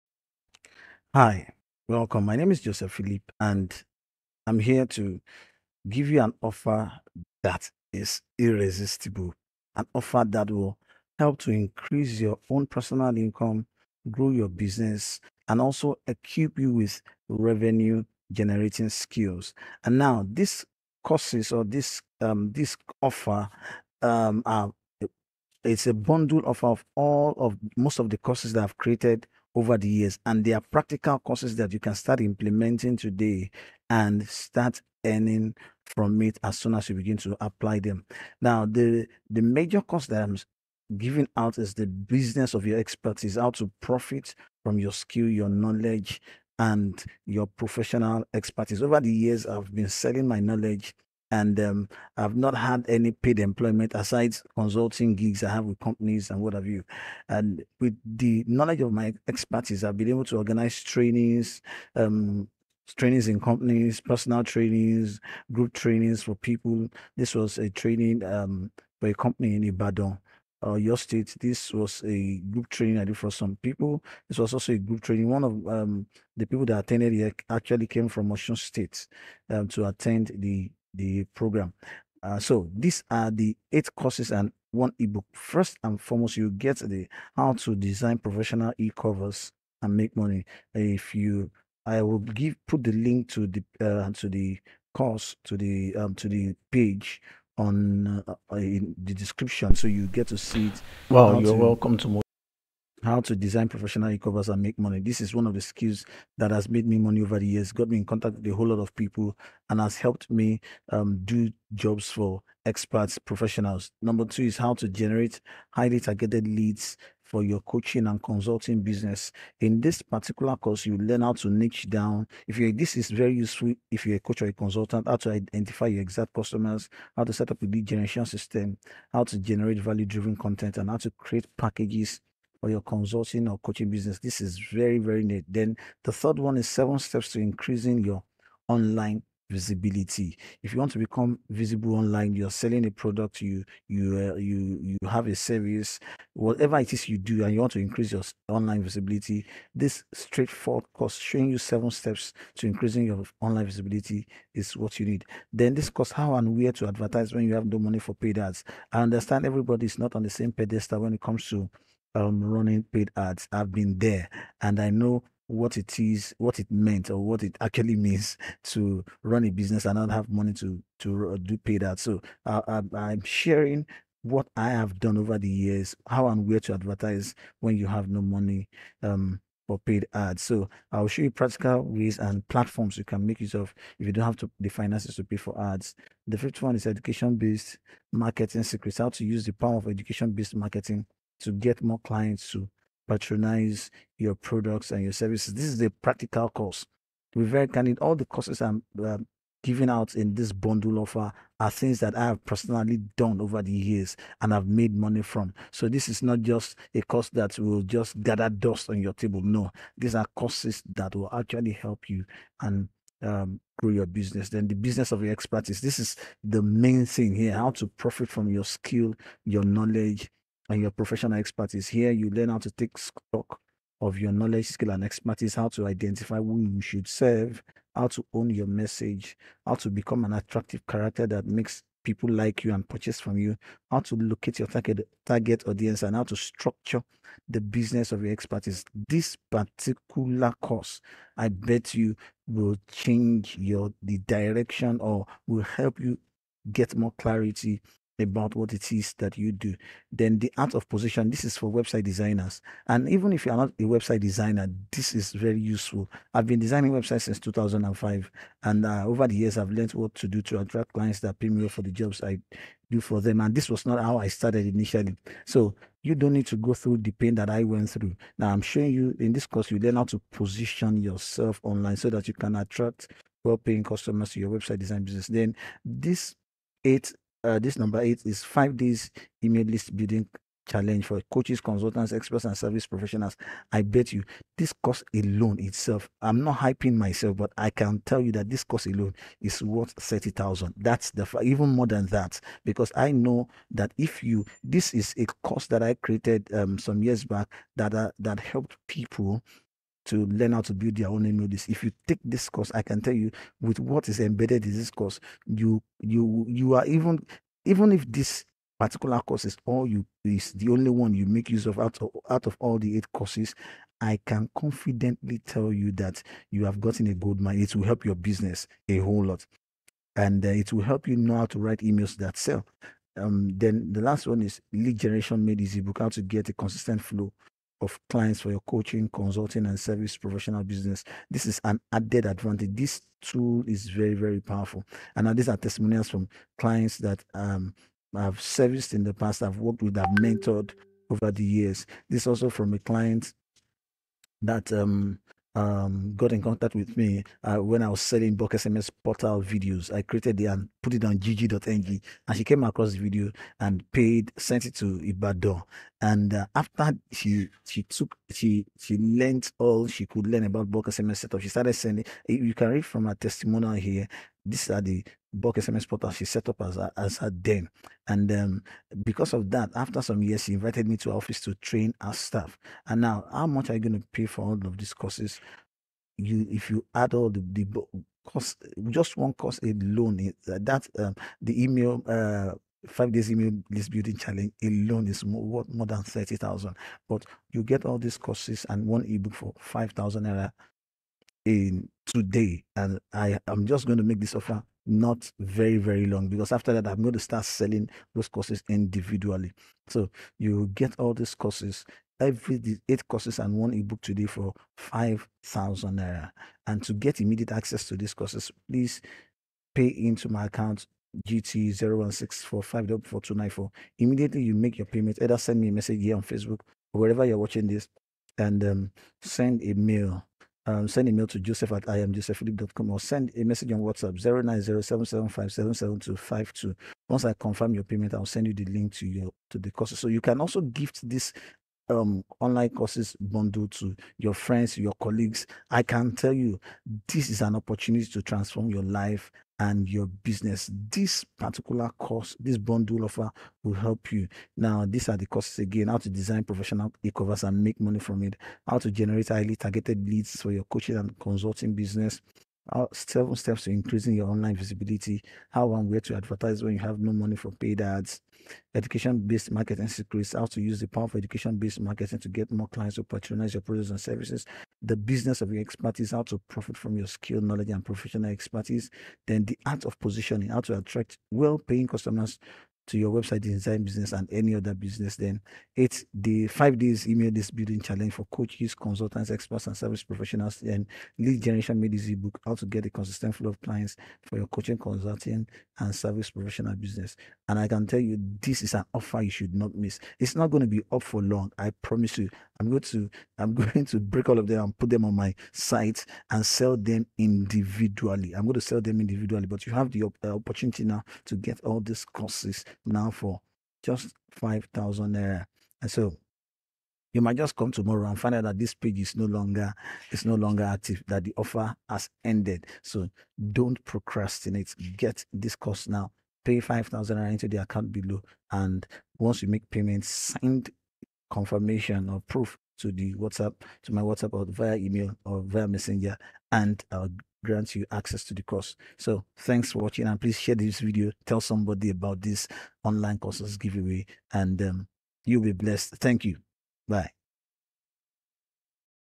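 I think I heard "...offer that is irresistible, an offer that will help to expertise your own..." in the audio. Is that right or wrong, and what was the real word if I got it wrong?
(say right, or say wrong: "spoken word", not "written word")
wrong: "increase", not "expertise".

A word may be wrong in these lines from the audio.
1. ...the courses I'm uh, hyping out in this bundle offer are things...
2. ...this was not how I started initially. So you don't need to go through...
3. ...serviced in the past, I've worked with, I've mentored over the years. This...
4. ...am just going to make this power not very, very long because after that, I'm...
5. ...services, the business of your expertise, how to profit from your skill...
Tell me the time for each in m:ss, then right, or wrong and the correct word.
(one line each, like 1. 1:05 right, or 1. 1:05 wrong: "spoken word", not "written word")
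1. 3:18 wrong: "giving", not "hyping"
2. 4:23 right
3. 5:38 right
4. 6:33 wrong: "offer", not "power"
5. 7:43 right.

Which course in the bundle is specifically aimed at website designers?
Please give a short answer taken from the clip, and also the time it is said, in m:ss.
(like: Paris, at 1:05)
The art of position, at 4:10.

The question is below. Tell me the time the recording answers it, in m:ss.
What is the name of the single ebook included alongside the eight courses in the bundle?
5:24.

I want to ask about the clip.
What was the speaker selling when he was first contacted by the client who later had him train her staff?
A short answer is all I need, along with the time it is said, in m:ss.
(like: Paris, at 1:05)
Bulk SMS portal videos, at 5:48.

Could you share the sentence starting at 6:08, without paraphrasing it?
And um, because of that, after some years, she invited me to her office to train our staff.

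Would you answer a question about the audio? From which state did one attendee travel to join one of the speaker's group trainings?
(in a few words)
Osun State.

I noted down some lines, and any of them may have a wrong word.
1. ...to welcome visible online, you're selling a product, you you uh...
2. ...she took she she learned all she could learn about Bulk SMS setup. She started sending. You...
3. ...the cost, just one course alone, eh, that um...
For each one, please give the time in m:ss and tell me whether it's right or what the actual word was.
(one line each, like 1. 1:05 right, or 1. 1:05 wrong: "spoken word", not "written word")
1. 2:20 wrong: "become", not "welcome"
2. 5:57 right
3. 6:17 right.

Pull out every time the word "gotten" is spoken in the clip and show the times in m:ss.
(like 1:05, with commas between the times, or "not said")
5:16.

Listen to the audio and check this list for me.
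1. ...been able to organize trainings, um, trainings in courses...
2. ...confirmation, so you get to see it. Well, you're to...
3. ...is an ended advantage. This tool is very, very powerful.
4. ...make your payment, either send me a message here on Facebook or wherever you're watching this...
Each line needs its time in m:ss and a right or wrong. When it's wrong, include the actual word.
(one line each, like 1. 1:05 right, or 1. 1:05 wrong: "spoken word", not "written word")
1. 0:59 wrong: "companies", not "courses"
2. 1:39 wrong: "description", not "confirmation"
3. 5:31 wrong: "added", not "ended"
4. 6:54 right.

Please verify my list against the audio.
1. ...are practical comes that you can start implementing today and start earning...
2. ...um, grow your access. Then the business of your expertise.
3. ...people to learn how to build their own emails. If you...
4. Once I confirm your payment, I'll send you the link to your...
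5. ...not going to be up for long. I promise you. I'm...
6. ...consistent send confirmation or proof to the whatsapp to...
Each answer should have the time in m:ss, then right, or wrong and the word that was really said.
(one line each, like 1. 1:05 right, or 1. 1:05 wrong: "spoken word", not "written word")
1. 0:30 wrong: "courses", not "comes"
2. 3:33 wrong: "business", not "access"
3. 4:58 right
4. 7:07 right
5. 8:10 right
6. 8:39 wrong: "payment", not "consistent".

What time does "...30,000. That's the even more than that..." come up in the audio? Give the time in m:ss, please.
4:49.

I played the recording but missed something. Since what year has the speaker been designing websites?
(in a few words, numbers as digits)
2005.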